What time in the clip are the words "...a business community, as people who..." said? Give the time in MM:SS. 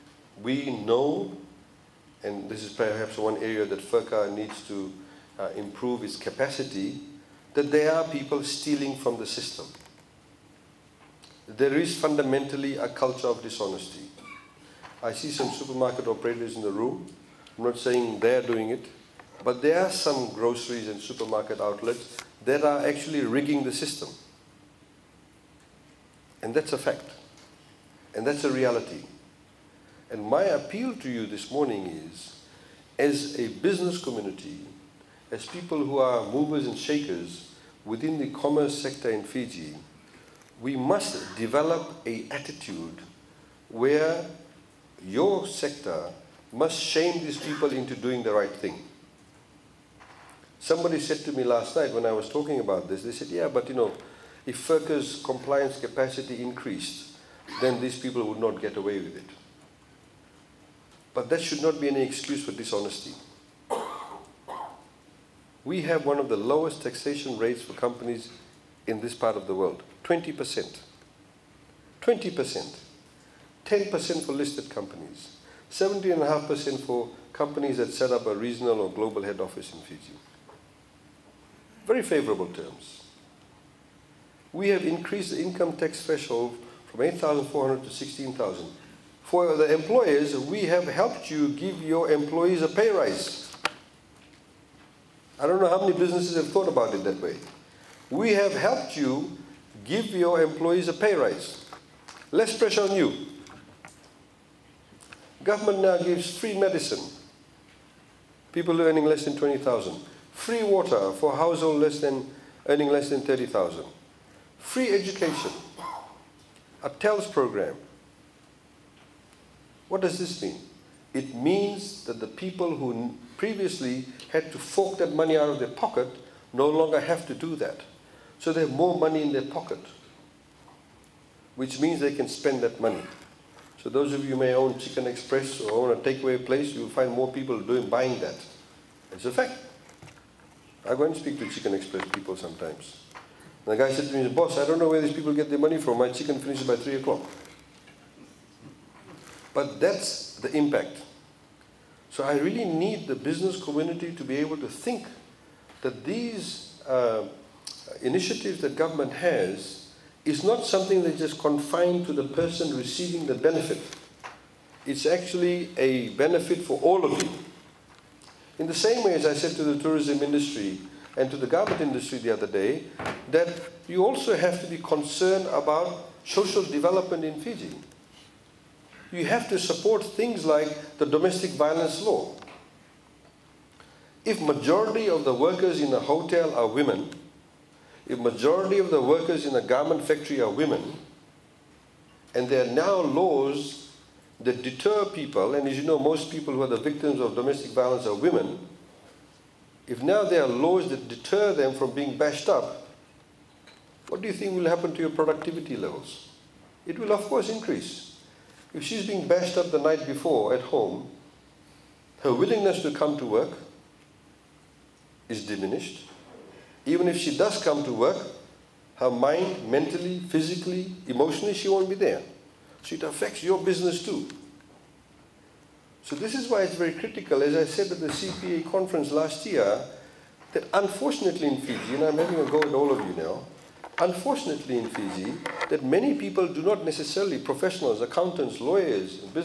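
00:33.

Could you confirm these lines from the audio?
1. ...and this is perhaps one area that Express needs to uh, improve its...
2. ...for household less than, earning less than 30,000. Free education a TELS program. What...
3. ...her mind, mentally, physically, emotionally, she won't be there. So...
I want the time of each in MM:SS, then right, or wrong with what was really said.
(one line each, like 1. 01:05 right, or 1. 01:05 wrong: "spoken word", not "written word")
1. 00:02 wrong: "FRCA", not "Express"
2. 01:51 right
3. 03:38 right.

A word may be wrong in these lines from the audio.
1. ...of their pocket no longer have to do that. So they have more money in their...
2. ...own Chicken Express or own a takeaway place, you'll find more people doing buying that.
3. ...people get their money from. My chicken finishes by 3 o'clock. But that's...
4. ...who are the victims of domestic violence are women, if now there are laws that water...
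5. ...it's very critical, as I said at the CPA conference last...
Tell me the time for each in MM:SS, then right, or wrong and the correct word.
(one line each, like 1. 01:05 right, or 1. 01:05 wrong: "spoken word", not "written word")
1. 02:05 right
2. 02:14 right
3. 02:25 right
4. 03:16 wrong: "deter", not "water"
5. 03:46 right.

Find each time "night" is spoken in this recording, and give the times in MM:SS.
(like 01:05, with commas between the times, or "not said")
00:51, 03:29.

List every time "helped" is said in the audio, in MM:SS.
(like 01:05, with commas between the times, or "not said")
01:30, 01:38.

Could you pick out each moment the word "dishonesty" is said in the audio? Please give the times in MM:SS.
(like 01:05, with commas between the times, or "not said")
00:13, 01:02.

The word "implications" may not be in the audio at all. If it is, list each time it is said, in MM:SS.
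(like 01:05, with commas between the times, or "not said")
not said.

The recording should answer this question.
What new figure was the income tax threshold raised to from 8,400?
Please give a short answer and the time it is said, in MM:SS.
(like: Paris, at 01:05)
16,000, at 01:27.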